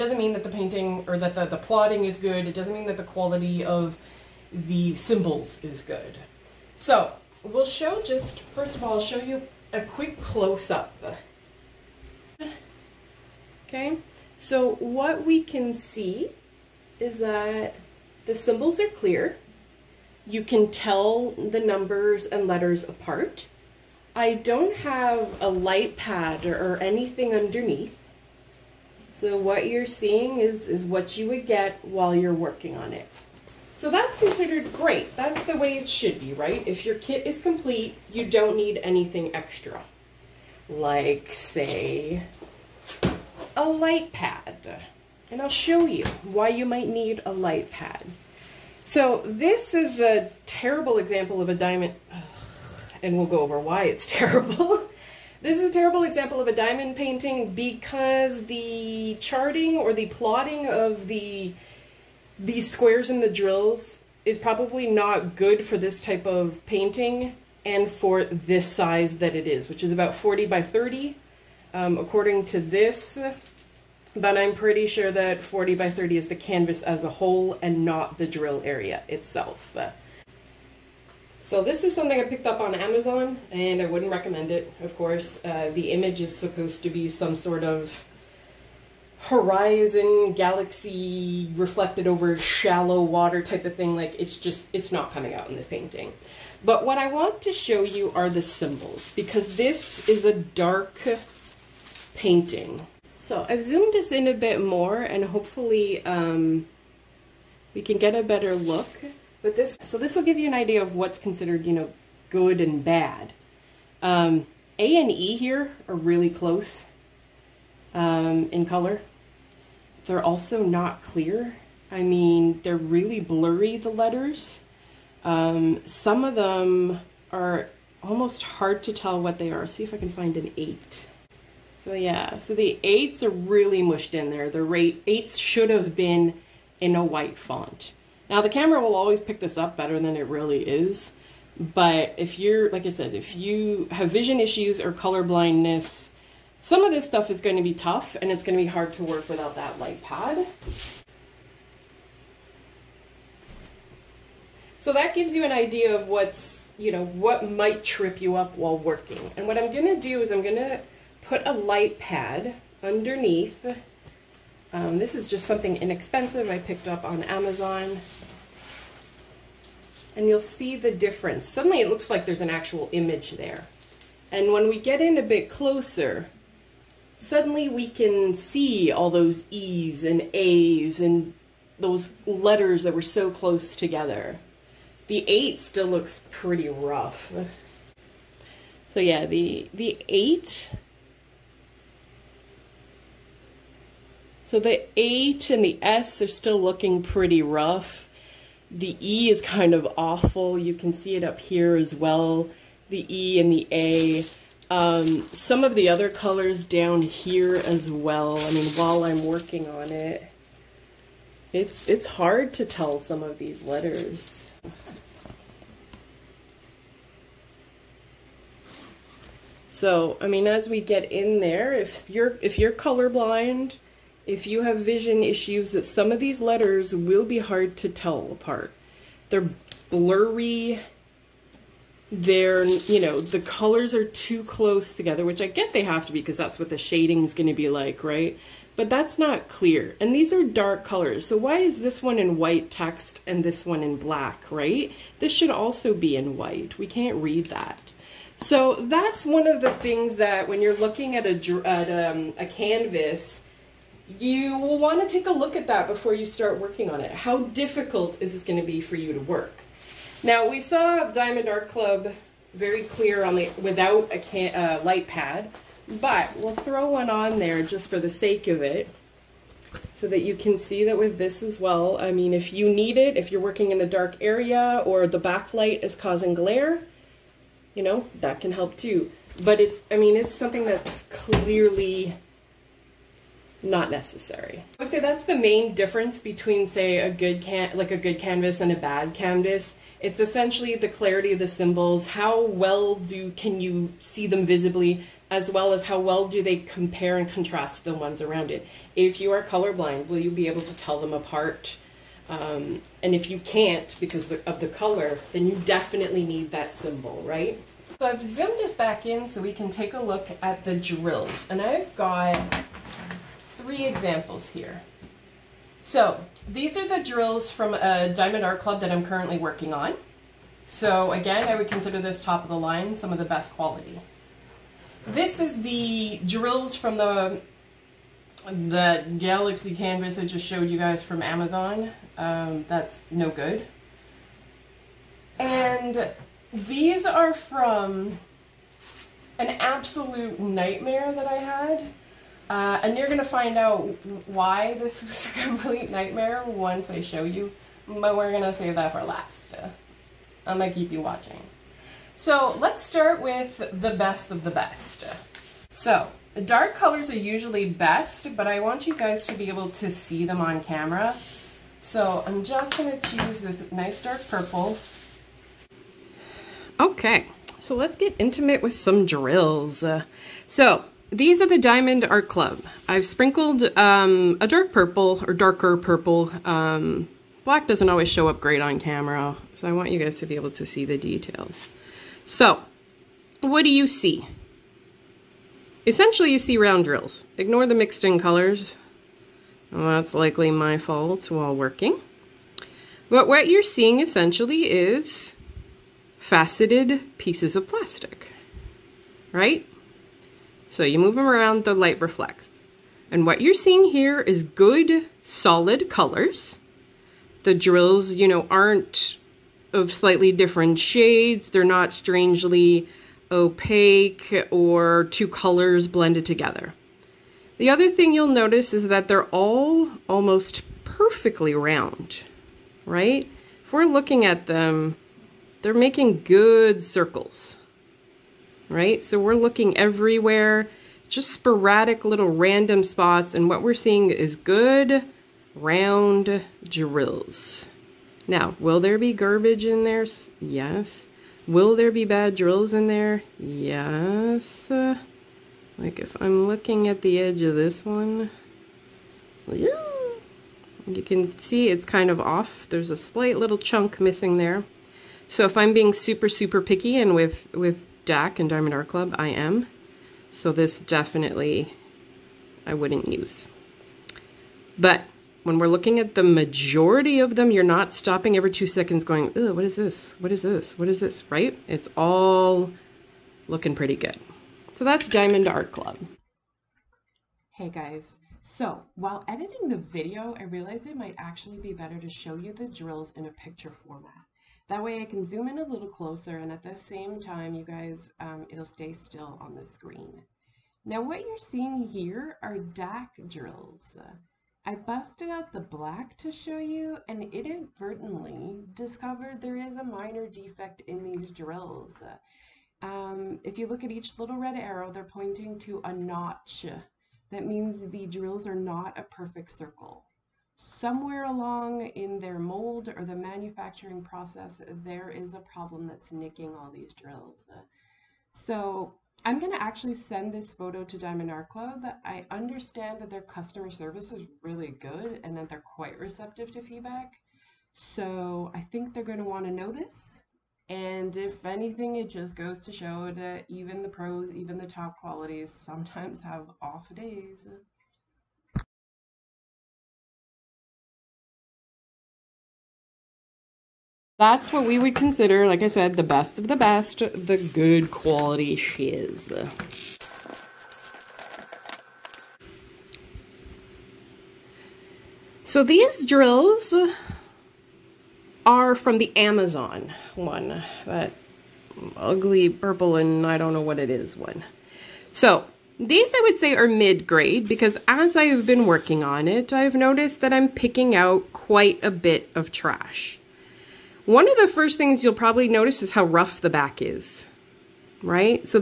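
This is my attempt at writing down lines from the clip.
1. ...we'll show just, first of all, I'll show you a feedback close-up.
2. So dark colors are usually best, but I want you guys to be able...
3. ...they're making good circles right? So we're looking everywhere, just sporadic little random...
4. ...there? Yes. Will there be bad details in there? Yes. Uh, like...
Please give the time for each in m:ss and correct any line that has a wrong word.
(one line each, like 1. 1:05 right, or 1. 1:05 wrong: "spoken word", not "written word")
1. 0:07 wrong: "quick", not "feedback"
2. 5:55 right
3. 7:05 right
4. 7:19 wrong: "drills", not "details".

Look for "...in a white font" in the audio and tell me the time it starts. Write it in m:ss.
2:16.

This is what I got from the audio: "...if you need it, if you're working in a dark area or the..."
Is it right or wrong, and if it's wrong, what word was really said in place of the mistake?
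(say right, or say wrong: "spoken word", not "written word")
right.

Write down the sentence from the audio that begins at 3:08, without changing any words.
So yeah, the the 8 So the H and the S are still looking pretty rough.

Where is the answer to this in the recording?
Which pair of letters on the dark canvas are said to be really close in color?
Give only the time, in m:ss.
1:54.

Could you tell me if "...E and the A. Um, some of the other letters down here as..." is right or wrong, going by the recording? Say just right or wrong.
wrong.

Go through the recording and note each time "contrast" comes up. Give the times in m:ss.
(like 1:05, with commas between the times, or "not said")
4:57.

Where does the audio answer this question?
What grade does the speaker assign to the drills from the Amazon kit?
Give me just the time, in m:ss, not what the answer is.
9:26.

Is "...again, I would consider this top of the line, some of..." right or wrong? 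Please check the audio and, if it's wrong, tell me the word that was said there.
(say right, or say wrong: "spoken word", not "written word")
right.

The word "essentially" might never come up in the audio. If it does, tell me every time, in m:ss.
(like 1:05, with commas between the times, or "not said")
4:50, 6:25, 6:33.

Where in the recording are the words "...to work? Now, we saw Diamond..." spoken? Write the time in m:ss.
4:19.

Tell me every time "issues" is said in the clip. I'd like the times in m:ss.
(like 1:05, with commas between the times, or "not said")
2:24, 3:45.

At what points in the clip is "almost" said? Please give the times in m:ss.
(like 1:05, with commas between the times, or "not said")
2:08, 7:00.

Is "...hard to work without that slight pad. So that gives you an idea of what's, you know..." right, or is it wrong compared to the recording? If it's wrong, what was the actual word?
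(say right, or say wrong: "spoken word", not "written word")
wrong: "light", not "slight".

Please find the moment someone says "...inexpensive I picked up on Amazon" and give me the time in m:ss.
2:45.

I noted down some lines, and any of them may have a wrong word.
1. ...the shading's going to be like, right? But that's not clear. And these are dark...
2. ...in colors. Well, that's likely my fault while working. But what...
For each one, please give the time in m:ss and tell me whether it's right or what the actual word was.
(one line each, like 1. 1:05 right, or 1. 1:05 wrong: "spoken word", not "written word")
1. 3:56 right
2. 6:28 right.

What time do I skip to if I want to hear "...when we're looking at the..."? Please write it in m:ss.
7:45.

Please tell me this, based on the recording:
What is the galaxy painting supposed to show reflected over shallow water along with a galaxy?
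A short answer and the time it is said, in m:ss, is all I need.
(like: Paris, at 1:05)
horizon, at 1:29.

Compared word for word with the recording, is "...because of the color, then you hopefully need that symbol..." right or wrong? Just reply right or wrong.
wrong.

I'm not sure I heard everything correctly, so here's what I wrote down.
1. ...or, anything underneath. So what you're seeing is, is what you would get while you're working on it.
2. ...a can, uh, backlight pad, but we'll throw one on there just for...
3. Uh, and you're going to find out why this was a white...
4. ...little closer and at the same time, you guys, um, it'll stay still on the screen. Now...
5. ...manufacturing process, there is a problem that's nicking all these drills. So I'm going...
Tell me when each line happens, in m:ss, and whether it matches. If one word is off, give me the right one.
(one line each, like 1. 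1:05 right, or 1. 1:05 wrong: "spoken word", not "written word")
1. 0:26 right
2. 4:24 wrong: "light", not "backlight"
3. 5:42 wrong: "complete", not "white"
4. 8:05 right
5. 8:33 right.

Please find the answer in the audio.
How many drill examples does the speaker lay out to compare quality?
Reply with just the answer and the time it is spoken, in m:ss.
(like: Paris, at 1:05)
3, at 5:13.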